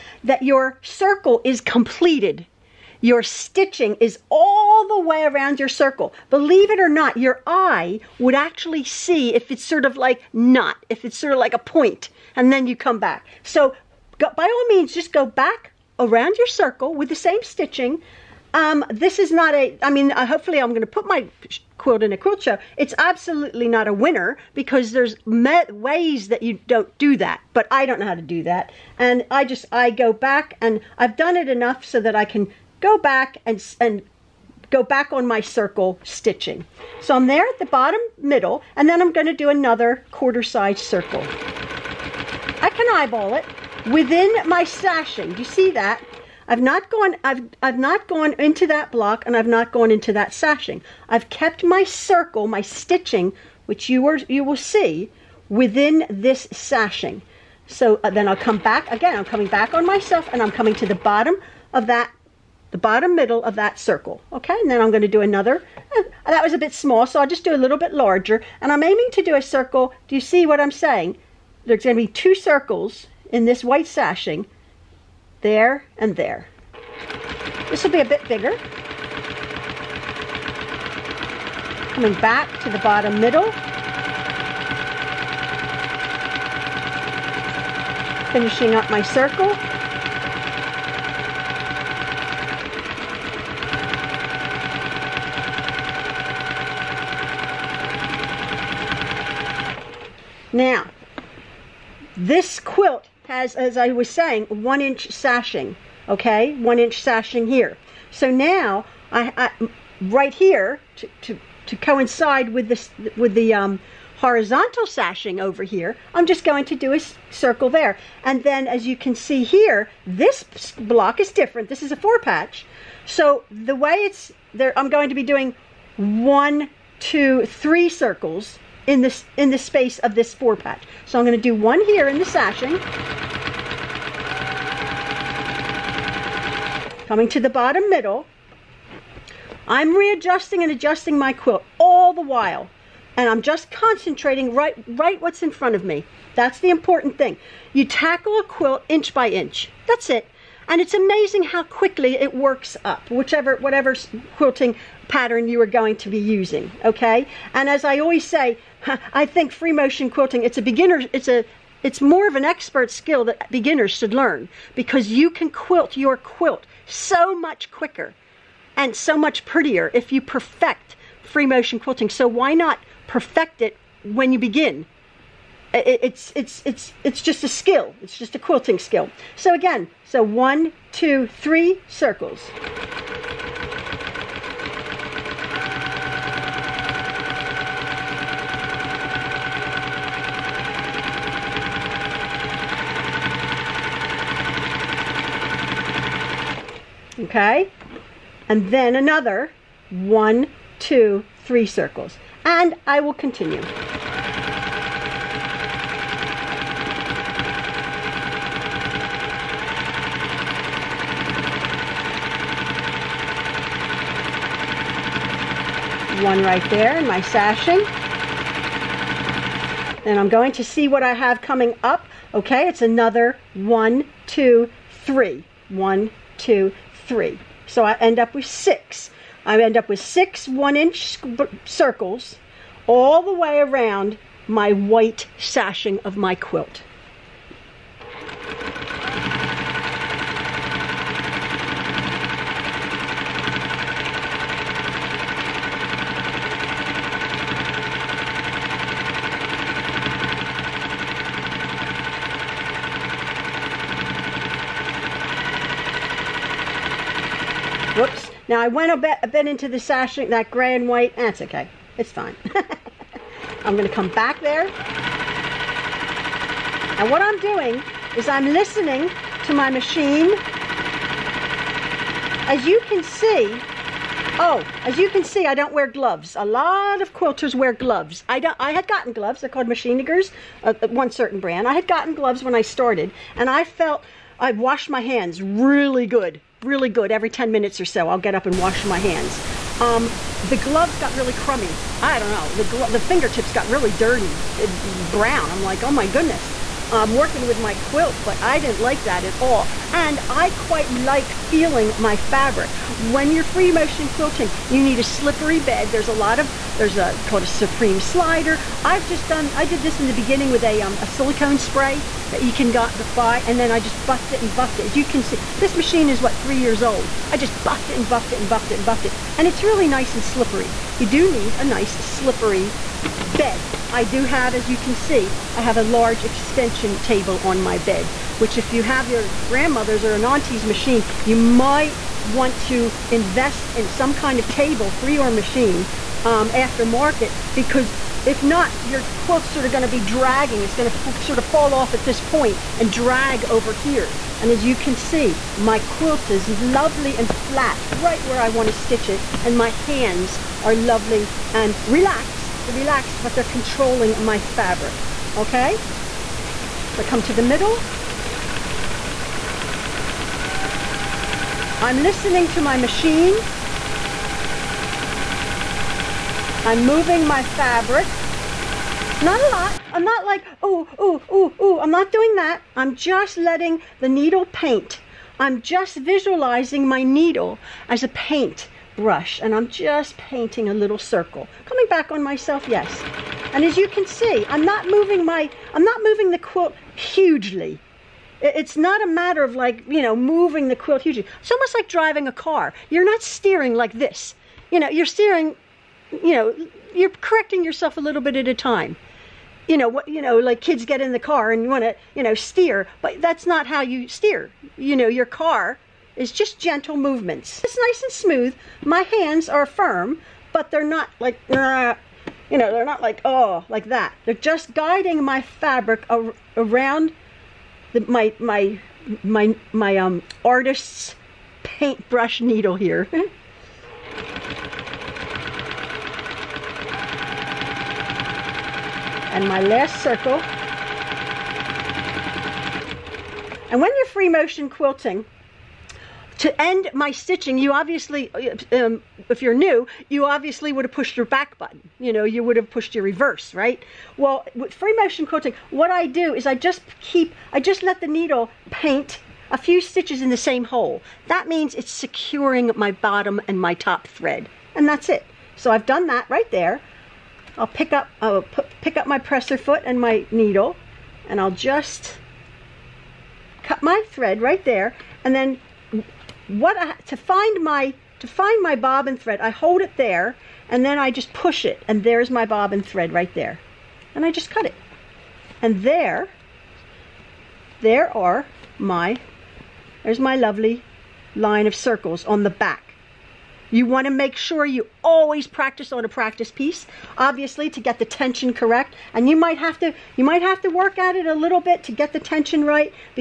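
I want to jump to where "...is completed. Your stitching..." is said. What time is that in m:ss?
0:01.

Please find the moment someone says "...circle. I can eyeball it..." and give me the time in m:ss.
0:40.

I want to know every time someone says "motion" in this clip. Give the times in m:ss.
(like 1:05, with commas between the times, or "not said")
2:39, 2:51, 5:03, 7:14, 7:24.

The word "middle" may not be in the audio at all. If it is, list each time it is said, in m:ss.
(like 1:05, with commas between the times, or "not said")
0:38, 1:03, 1:23, 2:17, 5:57.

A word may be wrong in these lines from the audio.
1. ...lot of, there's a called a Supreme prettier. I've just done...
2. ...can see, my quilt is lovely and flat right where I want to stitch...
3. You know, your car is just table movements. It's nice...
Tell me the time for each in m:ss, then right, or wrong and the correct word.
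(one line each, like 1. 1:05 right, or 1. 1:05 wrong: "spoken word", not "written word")
1. 5:06 wrong: "slider", not "prettier"
2. 5:44 right
3. 6:44 wrong: "gentle", not "table".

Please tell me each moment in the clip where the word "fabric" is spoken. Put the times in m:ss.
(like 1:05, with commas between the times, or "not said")
5:02, 5:54, 6:07, 6:55.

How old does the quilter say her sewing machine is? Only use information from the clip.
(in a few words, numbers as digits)
3 years old.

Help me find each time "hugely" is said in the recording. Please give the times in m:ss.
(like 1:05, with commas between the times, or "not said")
6:26, 6:31.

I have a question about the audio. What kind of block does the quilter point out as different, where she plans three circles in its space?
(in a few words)
A four patch.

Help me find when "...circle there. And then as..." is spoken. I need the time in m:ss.
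1:57.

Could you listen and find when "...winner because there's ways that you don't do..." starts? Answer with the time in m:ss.
0:23.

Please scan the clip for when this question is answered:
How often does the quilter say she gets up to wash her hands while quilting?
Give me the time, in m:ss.
4:47.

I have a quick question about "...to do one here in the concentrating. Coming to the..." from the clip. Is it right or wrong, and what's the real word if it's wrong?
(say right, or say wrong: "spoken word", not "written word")
wrong: "sashing", not "concentrating".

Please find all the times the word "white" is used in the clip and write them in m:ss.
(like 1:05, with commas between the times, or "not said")
1:13, 3:54, 4:20.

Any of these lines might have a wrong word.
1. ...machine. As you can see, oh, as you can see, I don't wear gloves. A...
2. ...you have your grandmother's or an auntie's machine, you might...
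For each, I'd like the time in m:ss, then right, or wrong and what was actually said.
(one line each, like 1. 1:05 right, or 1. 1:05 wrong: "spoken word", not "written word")
1. 4:29 right
2. 5:28 right.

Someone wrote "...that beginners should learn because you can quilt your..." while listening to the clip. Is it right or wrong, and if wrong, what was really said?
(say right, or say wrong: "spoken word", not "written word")
right.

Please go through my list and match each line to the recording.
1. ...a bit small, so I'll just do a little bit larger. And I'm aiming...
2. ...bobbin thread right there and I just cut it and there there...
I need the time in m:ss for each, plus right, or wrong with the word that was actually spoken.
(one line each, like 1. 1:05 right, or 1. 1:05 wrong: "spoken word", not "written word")
1. 1:06 right
2. 7:52 right.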